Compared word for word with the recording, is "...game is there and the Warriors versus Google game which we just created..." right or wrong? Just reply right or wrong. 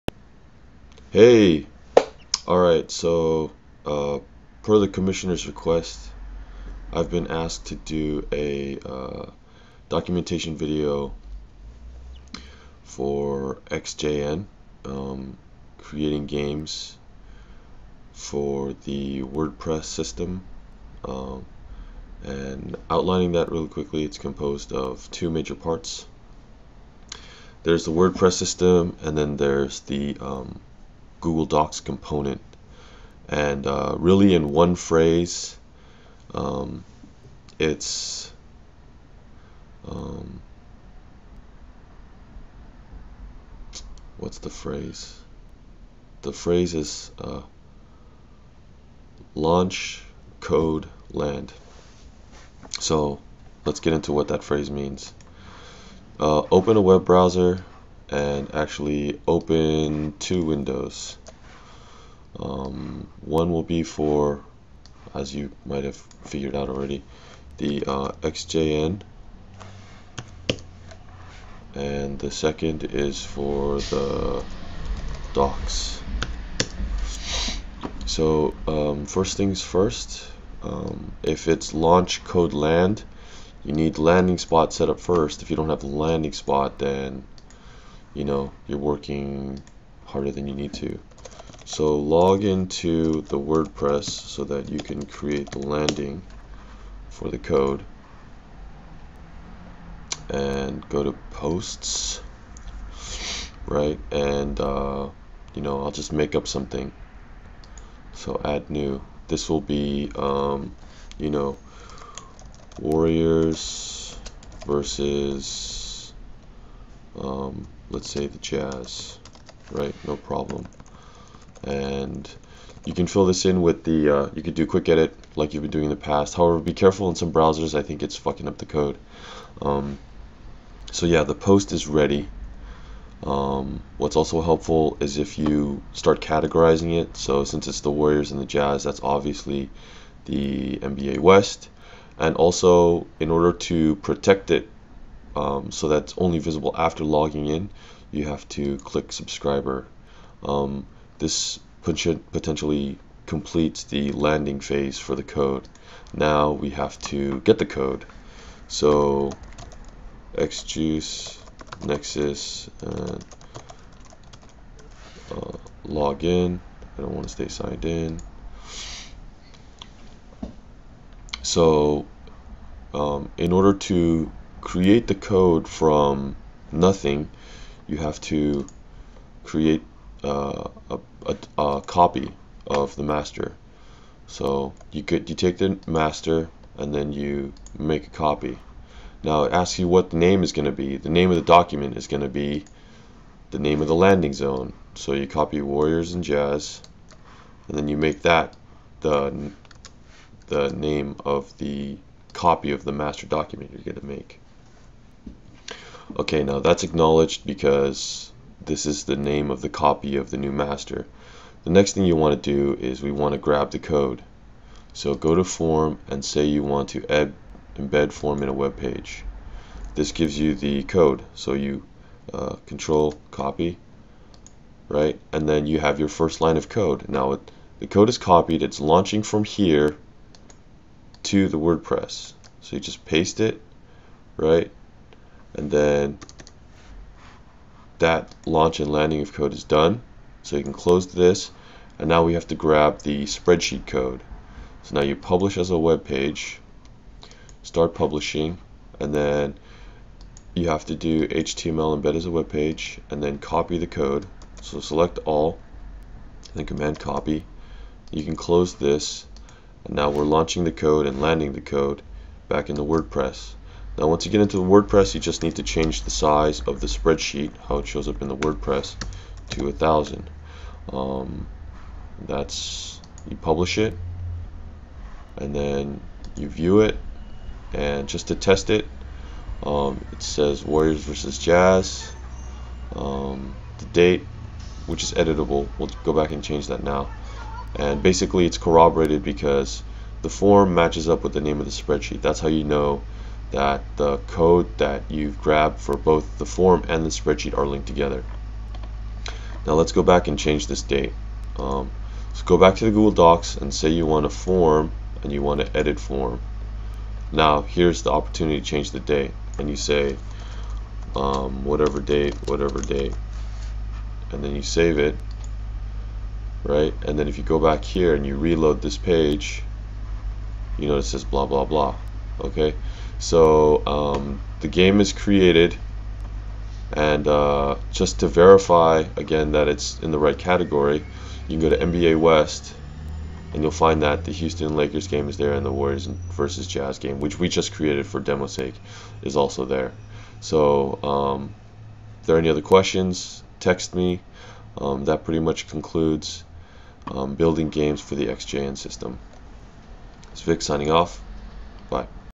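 wrong.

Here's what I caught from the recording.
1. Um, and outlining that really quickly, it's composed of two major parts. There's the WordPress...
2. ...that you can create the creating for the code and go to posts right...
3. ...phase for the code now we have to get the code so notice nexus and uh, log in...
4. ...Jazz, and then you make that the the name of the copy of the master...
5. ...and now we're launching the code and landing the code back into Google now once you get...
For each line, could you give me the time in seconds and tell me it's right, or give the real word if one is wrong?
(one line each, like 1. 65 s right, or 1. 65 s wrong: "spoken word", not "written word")
1. 21 s right
2. 94 s wrong: "landing", not "creating"
3. 154 s wrong: "xjuice", not "notice"
4. 196 s right
5. 259 s wrong: "WordPress", not "Google".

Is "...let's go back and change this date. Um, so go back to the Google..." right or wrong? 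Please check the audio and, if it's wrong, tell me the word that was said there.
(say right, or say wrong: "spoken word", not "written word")
right.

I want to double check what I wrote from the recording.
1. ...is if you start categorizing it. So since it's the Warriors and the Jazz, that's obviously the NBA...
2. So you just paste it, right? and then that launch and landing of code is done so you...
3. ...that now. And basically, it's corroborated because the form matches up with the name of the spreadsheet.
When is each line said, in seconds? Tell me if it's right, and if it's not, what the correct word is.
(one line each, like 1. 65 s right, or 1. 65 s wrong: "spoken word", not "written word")
1. 134 s right
2. 232 s right
3. 286 s right.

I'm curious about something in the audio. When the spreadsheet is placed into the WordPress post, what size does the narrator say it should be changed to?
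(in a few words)
1000.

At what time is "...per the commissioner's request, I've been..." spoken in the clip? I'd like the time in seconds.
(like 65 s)
4 s.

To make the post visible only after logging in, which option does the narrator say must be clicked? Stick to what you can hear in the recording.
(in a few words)
subscriber.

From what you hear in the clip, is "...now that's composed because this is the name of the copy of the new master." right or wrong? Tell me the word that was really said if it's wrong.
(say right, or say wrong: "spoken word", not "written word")
wrong: "acknowledged", not "composed".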